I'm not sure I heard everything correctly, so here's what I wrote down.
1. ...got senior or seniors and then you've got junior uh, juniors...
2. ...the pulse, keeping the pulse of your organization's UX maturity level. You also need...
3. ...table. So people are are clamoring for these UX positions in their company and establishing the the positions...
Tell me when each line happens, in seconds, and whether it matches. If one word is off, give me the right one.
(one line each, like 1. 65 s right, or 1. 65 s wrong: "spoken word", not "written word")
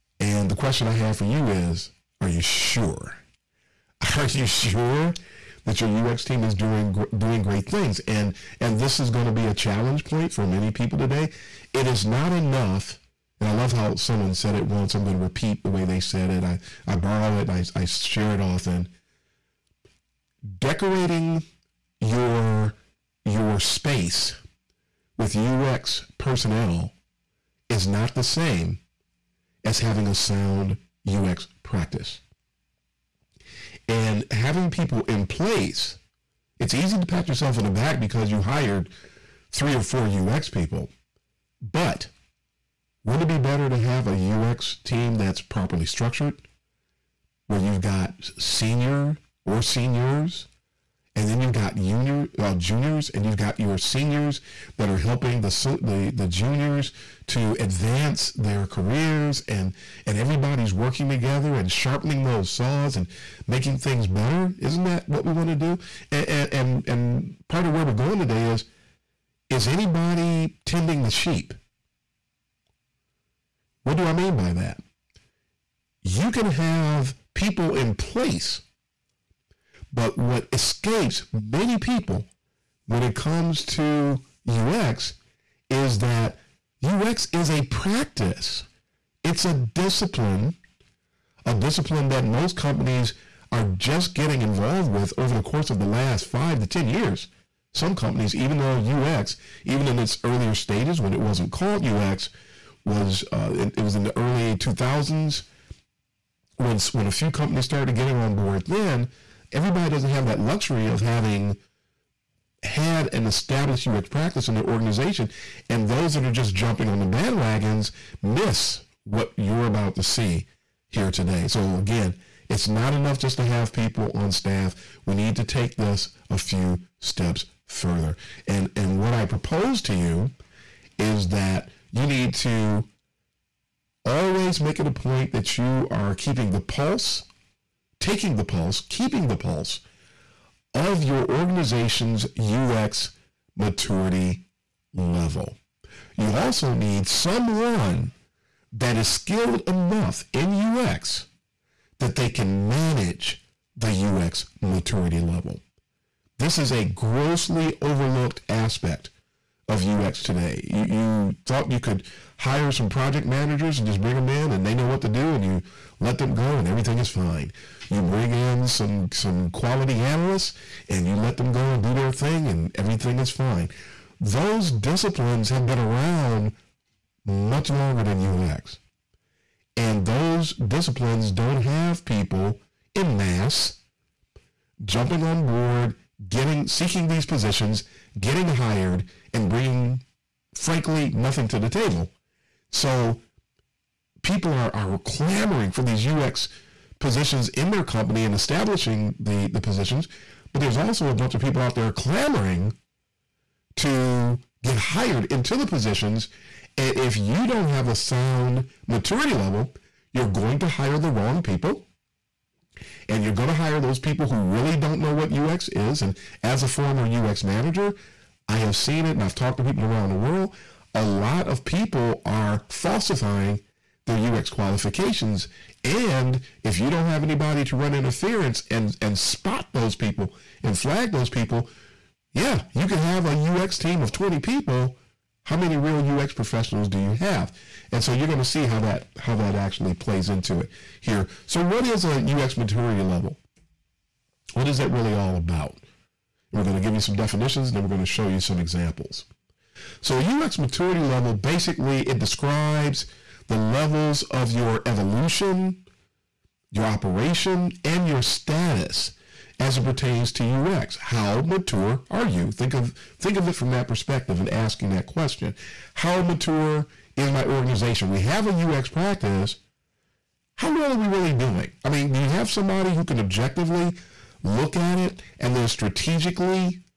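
1. 47 s right
2. 138 s right
3. 191 s right.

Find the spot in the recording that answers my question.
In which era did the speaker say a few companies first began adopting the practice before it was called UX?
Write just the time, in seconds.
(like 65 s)
104 s.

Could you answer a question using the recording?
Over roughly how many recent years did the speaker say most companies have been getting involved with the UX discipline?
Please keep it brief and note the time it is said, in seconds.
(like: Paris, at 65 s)
5 to 10 years, at 96 s.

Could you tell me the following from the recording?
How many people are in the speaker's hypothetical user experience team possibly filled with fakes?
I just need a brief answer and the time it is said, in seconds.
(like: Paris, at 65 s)
20, at 234 s.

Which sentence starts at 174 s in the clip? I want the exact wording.
Those disciplines have been around much longer than UX.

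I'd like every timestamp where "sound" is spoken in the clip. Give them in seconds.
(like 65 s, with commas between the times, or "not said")
30 s, 207 s.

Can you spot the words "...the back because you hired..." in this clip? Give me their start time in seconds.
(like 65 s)
37 s.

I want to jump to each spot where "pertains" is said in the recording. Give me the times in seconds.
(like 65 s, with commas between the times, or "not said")
259 s.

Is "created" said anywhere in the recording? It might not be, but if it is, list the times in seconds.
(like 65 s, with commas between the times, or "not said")
not said.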